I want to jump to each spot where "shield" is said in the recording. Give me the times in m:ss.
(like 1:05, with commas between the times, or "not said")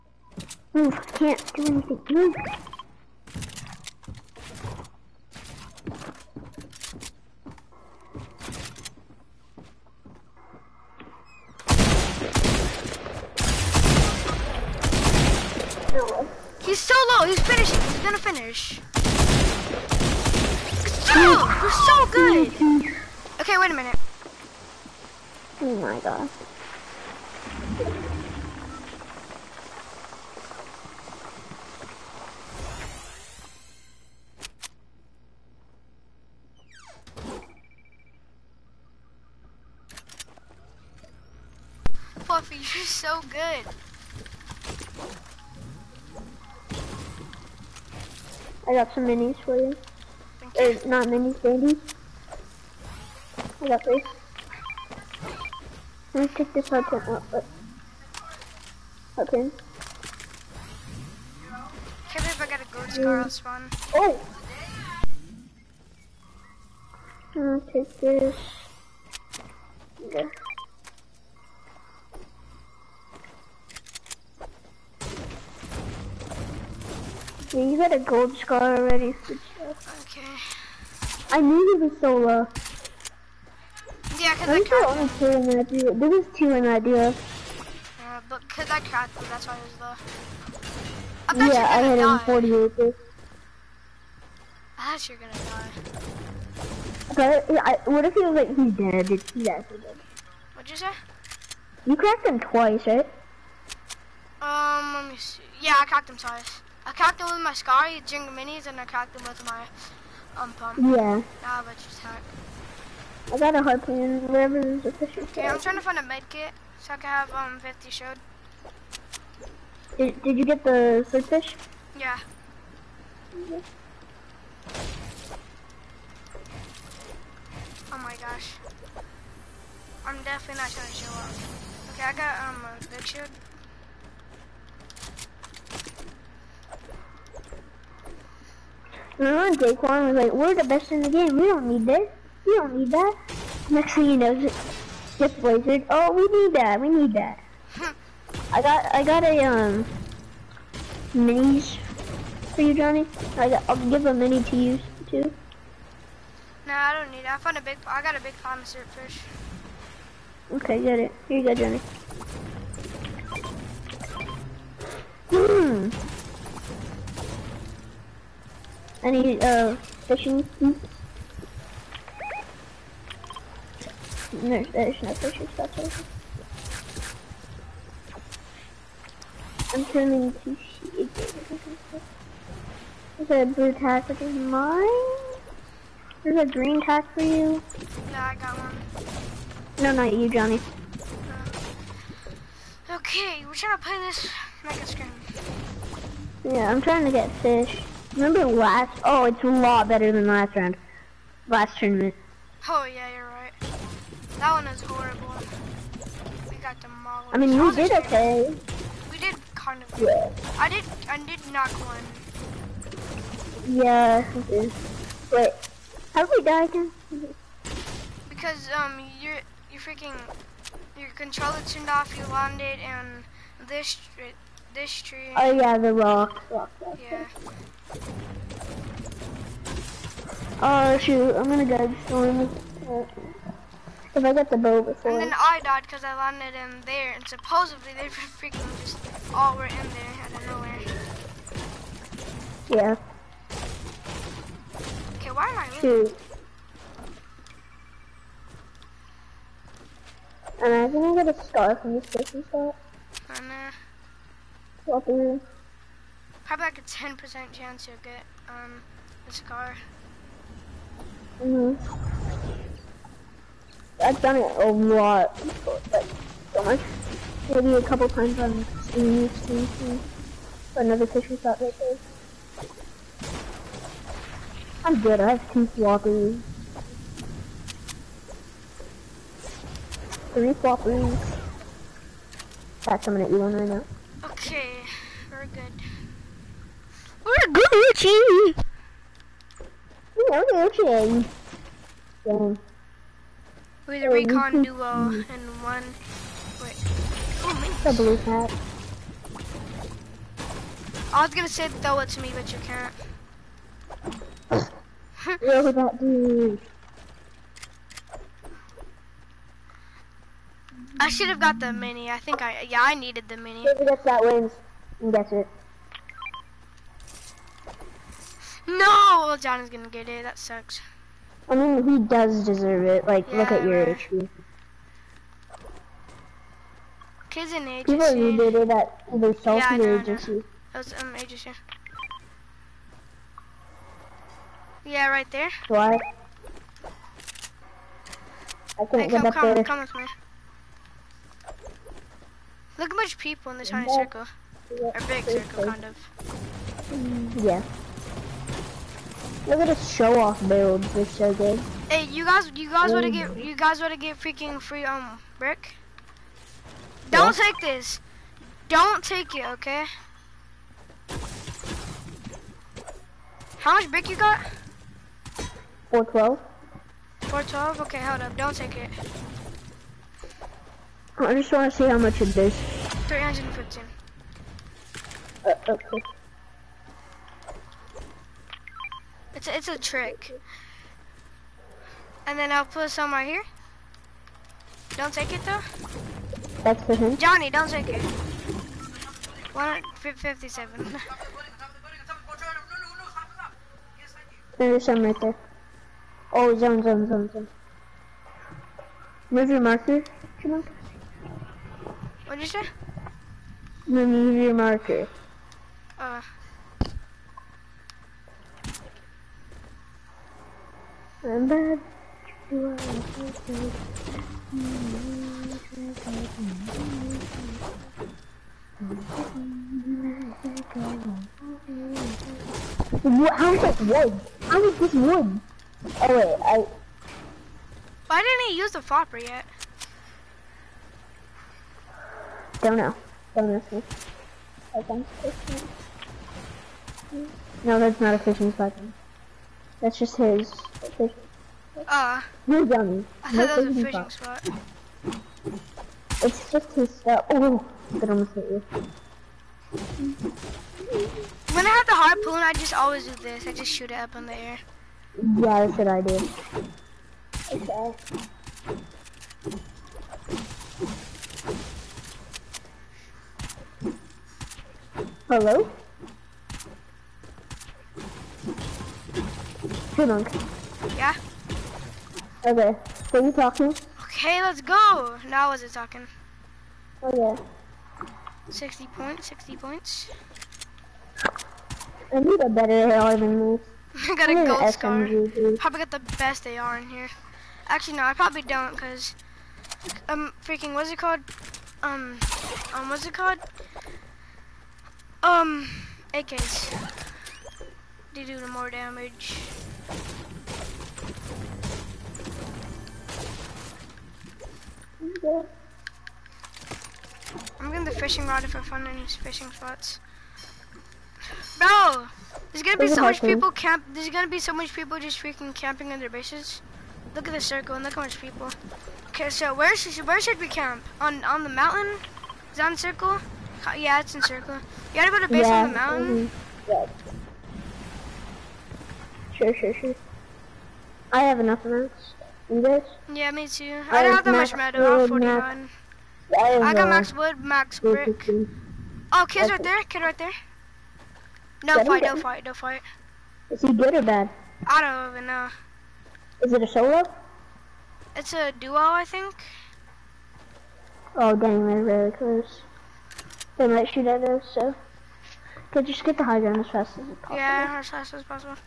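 1:57, 2:13.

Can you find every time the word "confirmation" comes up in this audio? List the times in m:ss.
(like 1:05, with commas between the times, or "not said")
not said.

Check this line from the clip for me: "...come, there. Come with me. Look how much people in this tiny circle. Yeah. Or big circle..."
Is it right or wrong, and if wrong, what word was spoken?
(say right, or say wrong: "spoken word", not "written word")
right.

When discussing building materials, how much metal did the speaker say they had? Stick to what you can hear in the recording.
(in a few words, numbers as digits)
41.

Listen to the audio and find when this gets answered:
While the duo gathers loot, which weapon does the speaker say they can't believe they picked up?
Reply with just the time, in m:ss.
1:02.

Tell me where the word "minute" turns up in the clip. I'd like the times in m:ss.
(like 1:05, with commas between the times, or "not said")
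0:23.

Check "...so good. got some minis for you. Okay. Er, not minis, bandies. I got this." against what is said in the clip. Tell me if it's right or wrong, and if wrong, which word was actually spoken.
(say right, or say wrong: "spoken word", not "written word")
right.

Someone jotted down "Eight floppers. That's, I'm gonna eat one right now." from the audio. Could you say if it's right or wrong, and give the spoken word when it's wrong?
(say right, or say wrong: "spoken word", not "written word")
wrong: "Three", not "Eight".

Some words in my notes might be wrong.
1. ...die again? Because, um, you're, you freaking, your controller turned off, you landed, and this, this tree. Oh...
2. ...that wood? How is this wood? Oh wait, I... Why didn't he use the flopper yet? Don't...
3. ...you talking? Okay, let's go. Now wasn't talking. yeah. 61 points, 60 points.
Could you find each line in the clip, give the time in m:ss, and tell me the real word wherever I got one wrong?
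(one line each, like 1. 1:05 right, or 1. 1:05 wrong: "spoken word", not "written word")
1. 3:36 right
2. 7:03 right
3. 7:53 wrong: "60", not "61".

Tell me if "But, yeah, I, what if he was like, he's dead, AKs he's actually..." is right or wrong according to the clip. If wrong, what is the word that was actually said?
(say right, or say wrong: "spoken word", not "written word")
wrong: "Did", not "AKs".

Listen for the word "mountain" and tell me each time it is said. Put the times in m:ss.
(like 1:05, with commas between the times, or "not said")
8:41, 8:45.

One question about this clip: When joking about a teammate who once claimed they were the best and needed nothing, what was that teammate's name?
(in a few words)
Daquan.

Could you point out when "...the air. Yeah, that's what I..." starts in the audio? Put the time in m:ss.
7:34.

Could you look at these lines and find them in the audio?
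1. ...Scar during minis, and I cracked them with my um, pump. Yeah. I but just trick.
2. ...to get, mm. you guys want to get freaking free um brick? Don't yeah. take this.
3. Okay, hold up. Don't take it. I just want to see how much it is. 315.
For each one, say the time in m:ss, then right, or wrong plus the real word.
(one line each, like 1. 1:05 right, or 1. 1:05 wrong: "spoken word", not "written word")
1. 1:47 wrong: "attack", not "trick"
2. 5:53 right
3. 6:07 right.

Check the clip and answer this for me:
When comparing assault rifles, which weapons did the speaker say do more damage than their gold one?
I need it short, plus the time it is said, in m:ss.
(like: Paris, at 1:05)
AKs, at 8:16.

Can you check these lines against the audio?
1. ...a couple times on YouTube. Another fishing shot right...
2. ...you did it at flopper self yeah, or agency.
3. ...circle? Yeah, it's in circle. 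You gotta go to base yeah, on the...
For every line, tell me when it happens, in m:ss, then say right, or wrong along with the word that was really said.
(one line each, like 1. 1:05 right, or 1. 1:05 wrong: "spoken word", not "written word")
1. 4:27 right
2. 5:28 wrong: "either", not "flopper"
3. 8:42 right.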